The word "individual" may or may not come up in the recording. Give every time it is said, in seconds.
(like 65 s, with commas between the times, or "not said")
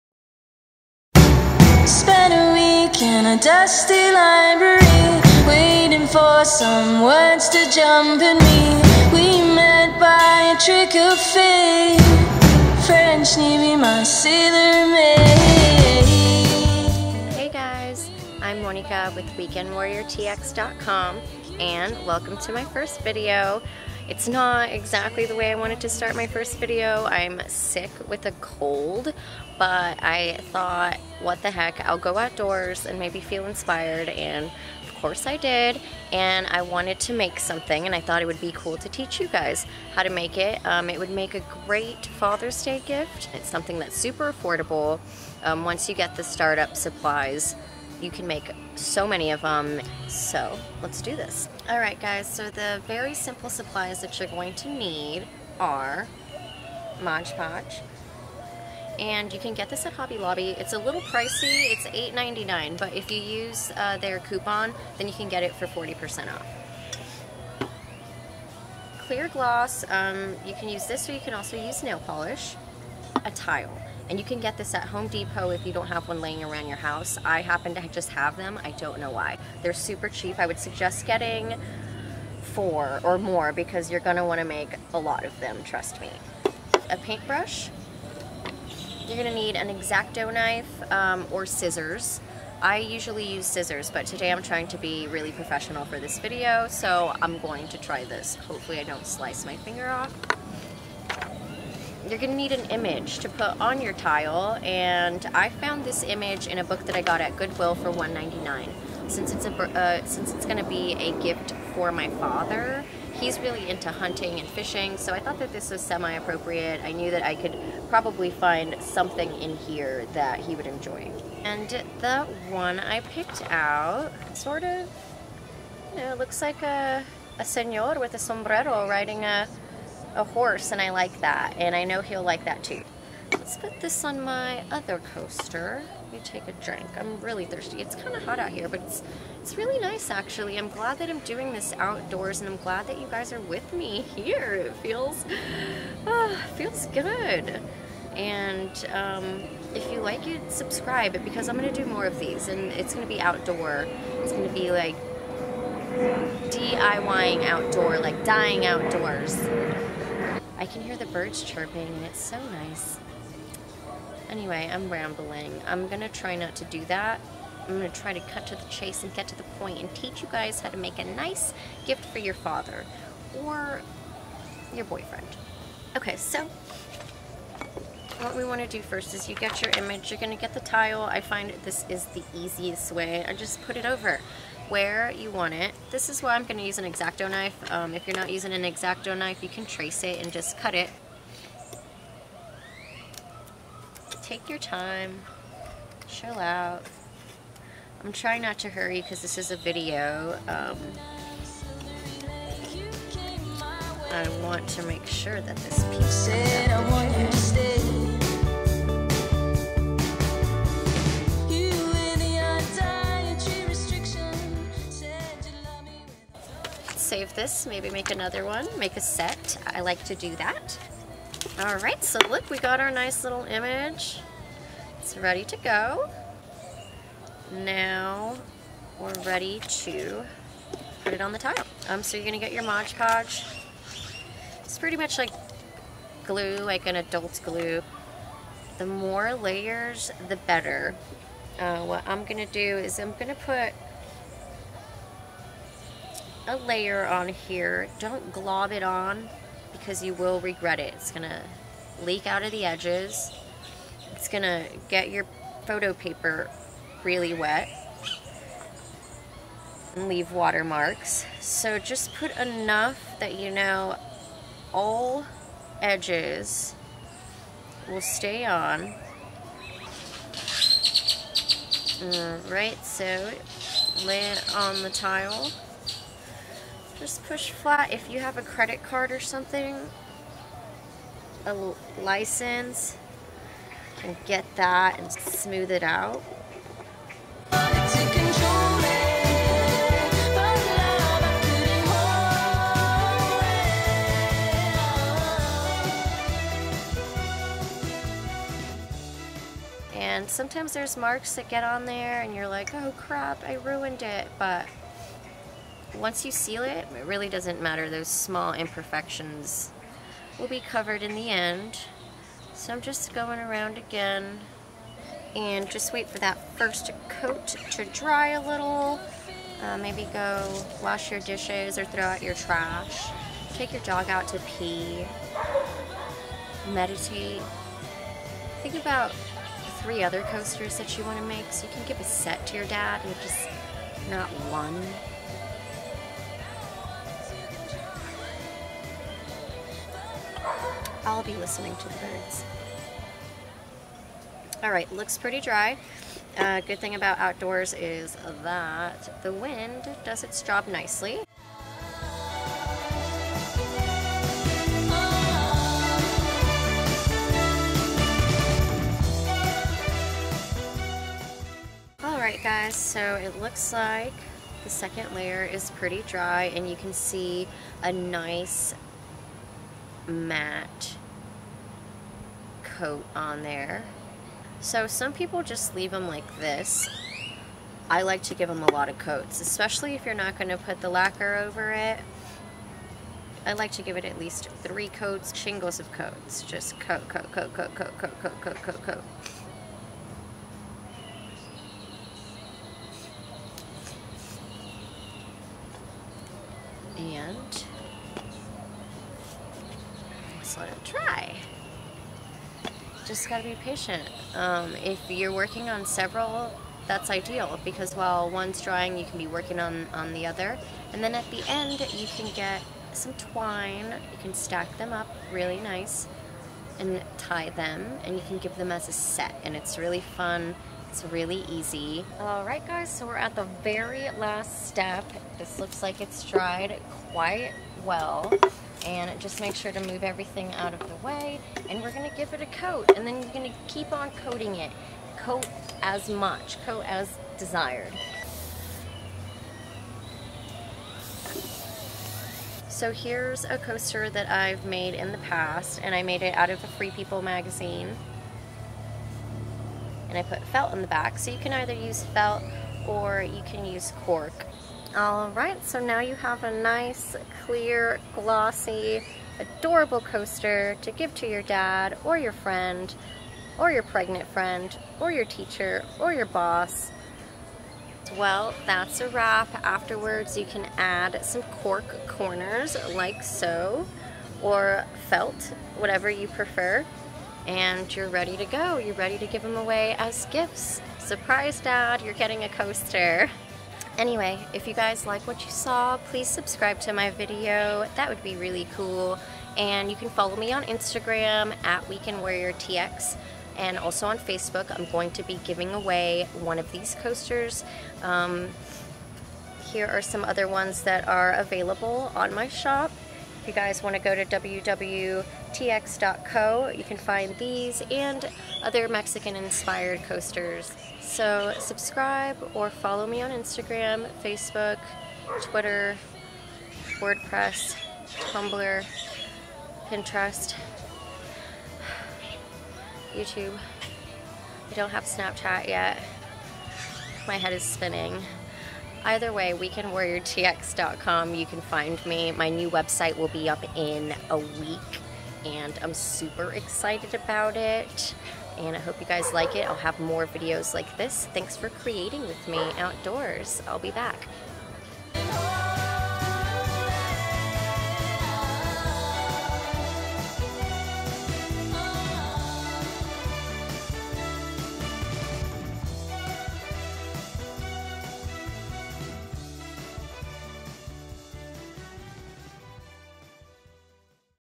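not said.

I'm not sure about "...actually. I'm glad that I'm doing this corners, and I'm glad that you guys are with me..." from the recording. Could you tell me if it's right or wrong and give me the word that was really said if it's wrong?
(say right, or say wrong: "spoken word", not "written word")
wrong: "outdoors", not "corners".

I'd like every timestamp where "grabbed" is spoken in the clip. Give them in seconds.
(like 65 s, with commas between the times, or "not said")
not said.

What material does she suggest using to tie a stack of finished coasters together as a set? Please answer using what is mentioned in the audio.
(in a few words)
twine.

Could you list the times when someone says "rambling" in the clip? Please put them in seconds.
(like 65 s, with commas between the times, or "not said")
164 s.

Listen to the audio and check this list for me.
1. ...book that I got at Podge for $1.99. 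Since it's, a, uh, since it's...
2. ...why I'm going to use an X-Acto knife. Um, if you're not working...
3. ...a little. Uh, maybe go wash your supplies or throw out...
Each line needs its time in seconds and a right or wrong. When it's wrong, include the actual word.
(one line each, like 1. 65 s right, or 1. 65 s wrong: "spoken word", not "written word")
1. 106 s wrong: "Goodwill", not "Podge"
2. 186 s wrong: "using", not "working"
3. 318 s wrong: "dishes", not "supplies".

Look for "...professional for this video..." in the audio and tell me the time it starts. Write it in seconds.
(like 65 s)
95 s.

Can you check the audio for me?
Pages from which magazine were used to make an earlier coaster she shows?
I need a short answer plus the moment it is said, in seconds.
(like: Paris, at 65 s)
Free People, at 446 s.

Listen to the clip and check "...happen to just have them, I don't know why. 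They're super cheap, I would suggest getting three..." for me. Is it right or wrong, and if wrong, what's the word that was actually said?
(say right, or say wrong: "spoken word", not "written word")
wrong: "four", not "three".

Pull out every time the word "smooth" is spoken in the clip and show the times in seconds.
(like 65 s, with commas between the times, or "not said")
285 s.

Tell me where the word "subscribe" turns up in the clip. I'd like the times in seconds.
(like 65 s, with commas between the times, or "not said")
150 s, 486 s, 511 s.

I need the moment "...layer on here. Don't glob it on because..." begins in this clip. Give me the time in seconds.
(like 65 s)
246 s.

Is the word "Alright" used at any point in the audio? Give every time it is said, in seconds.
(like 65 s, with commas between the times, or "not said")
362 s, 454 s.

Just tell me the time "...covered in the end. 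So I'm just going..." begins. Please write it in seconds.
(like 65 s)
310 s.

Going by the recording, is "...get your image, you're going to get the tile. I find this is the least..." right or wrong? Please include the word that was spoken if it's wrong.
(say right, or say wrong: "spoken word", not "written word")
wrong: "easiest", not "least".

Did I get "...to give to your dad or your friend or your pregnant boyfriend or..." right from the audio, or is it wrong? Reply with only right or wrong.
wrong.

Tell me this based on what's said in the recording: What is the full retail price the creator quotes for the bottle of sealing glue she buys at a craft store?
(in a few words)
$8.99.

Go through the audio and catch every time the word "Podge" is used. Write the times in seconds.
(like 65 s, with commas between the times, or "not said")
57 s, 232 s.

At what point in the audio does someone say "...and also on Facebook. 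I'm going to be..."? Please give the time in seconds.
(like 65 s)
493 s.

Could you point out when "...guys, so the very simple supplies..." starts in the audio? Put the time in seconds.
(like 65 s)
52 s.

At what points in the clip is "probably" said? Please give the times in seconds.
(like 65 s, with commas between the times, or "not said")
117 s.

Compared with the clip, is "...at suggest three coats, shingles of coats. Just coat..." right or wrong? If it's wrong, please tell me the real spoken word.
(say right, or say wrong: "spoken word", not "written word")
wrong: "least", not "suggest".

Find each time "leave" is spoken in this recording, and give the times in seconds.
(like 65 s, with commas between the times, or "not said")
260 s, 375 s.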